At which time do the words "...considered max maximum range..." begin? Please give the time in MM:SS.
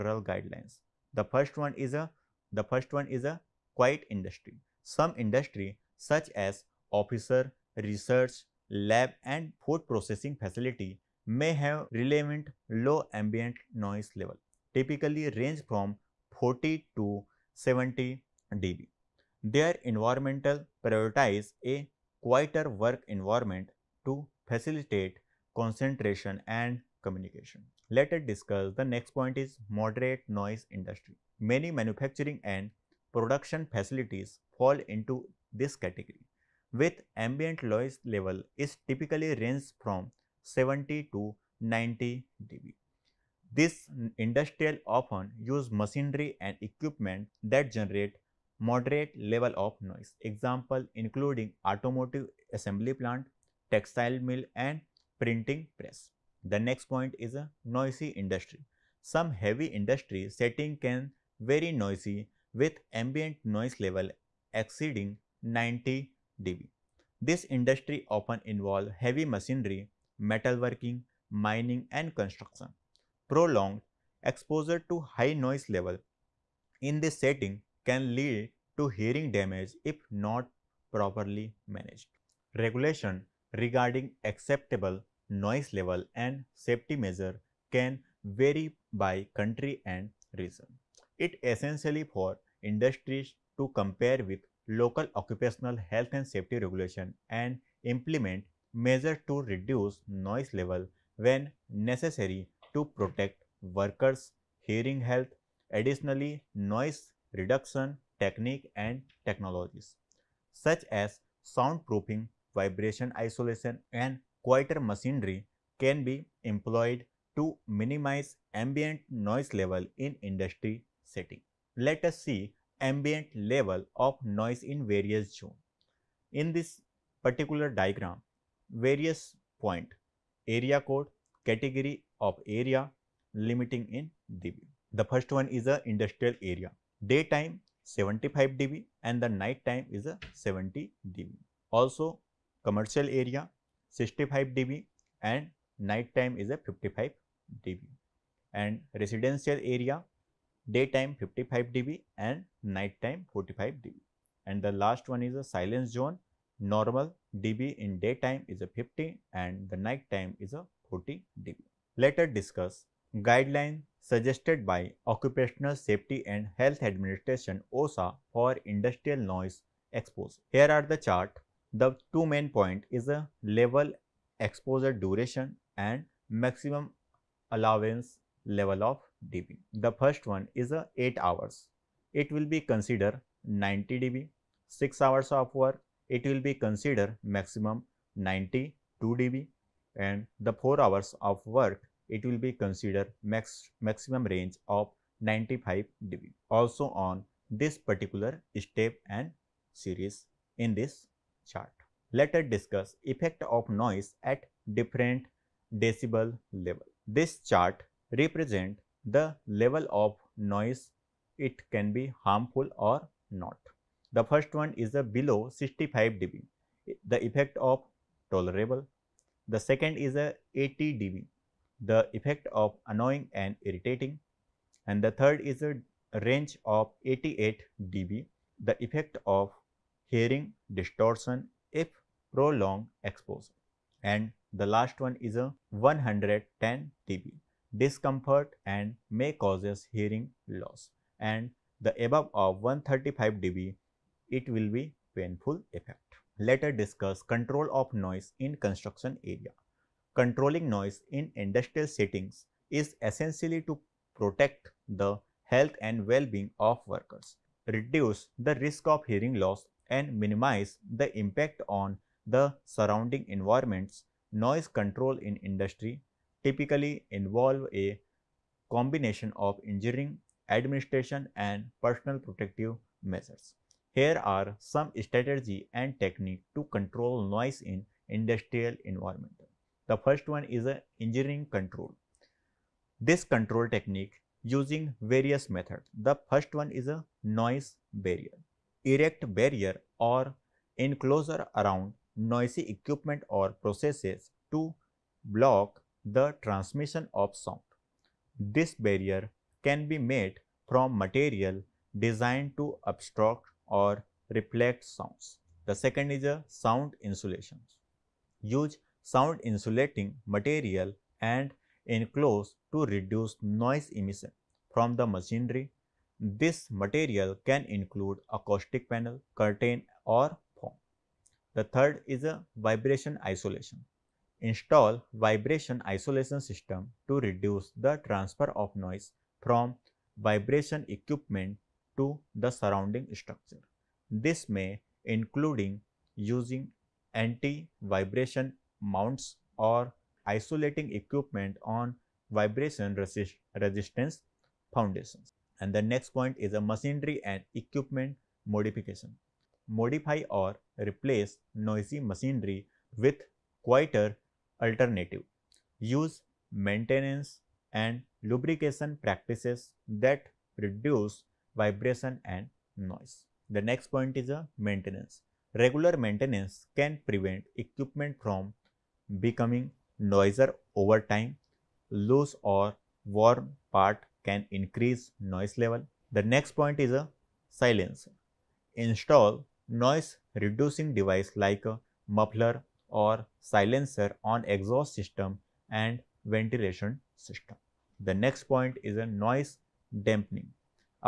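03:12.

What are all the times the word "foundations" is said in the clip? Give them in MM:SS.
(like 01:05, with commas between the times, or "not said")
05:44.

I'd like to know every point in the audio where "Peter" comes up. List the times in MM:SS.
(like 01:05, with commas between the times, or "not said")
not said.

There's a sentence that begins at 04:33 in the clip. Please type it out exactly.
Here are some strategy and technique to control noise in industrial environment.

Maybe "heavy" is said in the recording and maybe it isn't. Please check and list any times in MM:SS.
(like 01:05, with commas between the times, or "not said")
00:59, 01:08.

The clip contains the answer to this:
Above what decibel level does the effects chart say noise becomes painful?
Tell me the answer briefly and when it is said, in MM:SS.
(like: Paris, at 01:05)
135 dB, at 04:02.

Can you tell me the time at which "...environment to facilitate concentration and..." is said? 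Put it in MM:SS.
00:23.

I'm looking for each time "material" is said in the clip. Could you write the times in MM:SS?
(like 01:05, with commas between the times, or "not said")
05:00, 05:10, 05:16.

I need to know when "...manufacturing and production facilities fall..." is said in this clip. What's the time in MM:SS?
00:31.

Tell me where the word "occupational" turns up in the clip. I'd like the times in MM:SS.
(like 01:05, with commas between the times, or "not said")
01:35, 02:45.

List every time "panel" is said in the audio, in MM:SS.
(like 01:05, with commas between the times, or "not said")
05:18.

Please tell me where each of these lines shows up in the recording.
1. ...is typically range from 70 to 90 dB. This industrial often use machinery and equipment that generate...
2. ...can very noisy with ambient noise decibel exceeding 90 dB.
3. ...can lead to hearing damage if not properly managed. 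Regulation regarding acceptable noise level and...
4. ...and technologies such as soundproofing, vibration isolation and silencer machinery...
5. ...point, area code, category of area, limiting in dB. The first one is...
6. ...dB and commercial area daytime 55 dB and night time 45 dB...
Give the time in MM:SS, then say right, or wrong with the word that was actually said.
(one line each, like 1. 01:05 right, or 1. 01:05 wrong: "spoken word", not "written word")
1. 00:38 right
2. 01:00 wrong: "level", not "decibel"
3. 01:17 right
4. 01:48 wrong: "quieter", not "silencer"
5. 02:09 right
6. 02:27 wrong: "residential", not "commercial".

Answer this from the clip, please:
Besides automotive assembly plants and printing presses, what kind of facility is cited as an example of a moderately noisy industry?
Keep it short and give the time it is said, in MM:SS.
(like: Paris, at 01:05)
textile mill, at 00:53.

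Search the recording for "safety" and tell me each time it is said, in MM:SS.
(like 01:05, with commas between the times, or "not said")
01:26, 01:36, 02:45.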